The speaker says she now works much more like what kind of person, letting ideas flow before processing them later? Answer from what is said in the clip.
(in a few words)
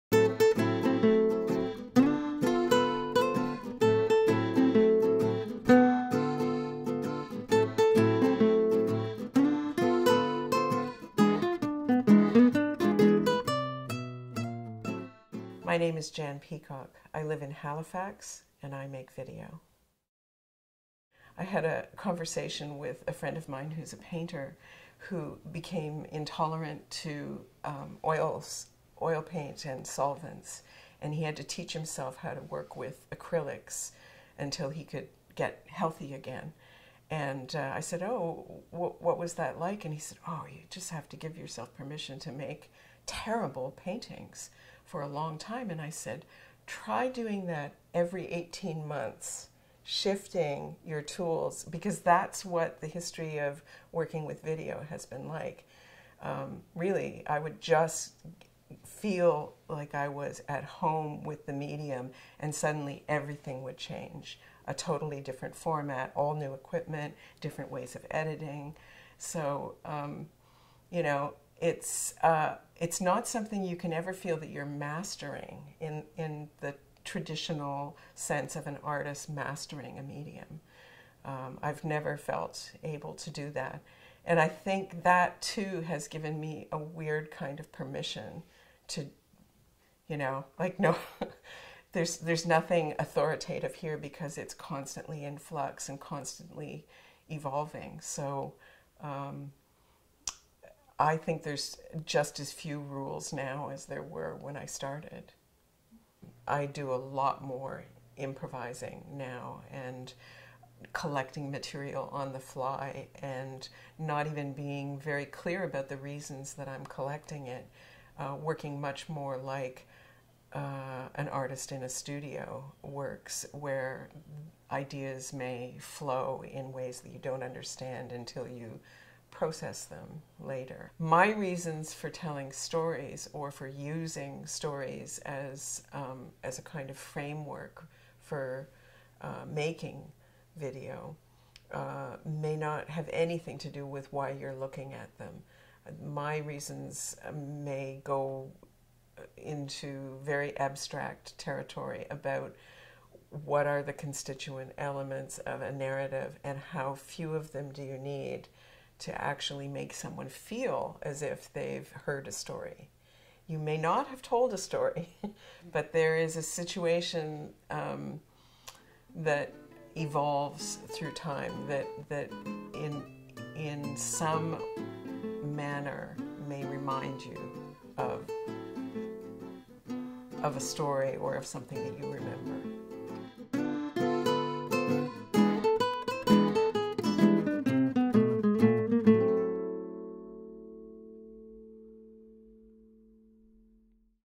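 an artist in a studio.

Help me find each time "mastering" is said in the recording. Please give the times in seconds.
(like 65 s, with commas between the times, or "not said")
74 s, 79 s.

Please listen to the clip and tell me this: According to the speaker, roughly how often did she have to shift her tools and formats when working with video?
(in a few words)
every 18 months.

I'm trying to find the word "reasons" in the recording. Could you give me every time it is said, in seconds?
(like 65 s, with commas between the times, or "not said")
115 s, 131 s, 146 s.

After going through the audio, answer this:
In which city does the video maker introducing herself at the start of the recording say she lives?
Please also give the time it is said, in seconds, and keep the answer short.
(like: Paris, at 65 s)
Halifax, at 17 s.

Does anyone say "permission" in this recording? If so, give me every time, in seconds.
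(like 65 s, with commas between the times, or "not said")
41 s, 87 s.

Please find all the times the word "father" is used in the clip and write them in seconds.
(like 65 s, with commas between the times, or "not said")
not said.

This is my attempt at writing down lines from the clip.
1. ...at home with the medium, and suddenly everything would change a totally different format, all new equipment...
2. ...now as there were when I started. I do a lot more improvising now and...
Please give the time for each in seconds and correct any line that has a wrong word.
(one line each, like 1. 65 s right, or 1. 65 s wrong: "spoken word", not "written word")
1. 60 s right
2. 103 s right.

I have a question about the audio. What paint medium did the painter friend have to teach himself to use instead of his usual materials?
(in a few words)
acrylics.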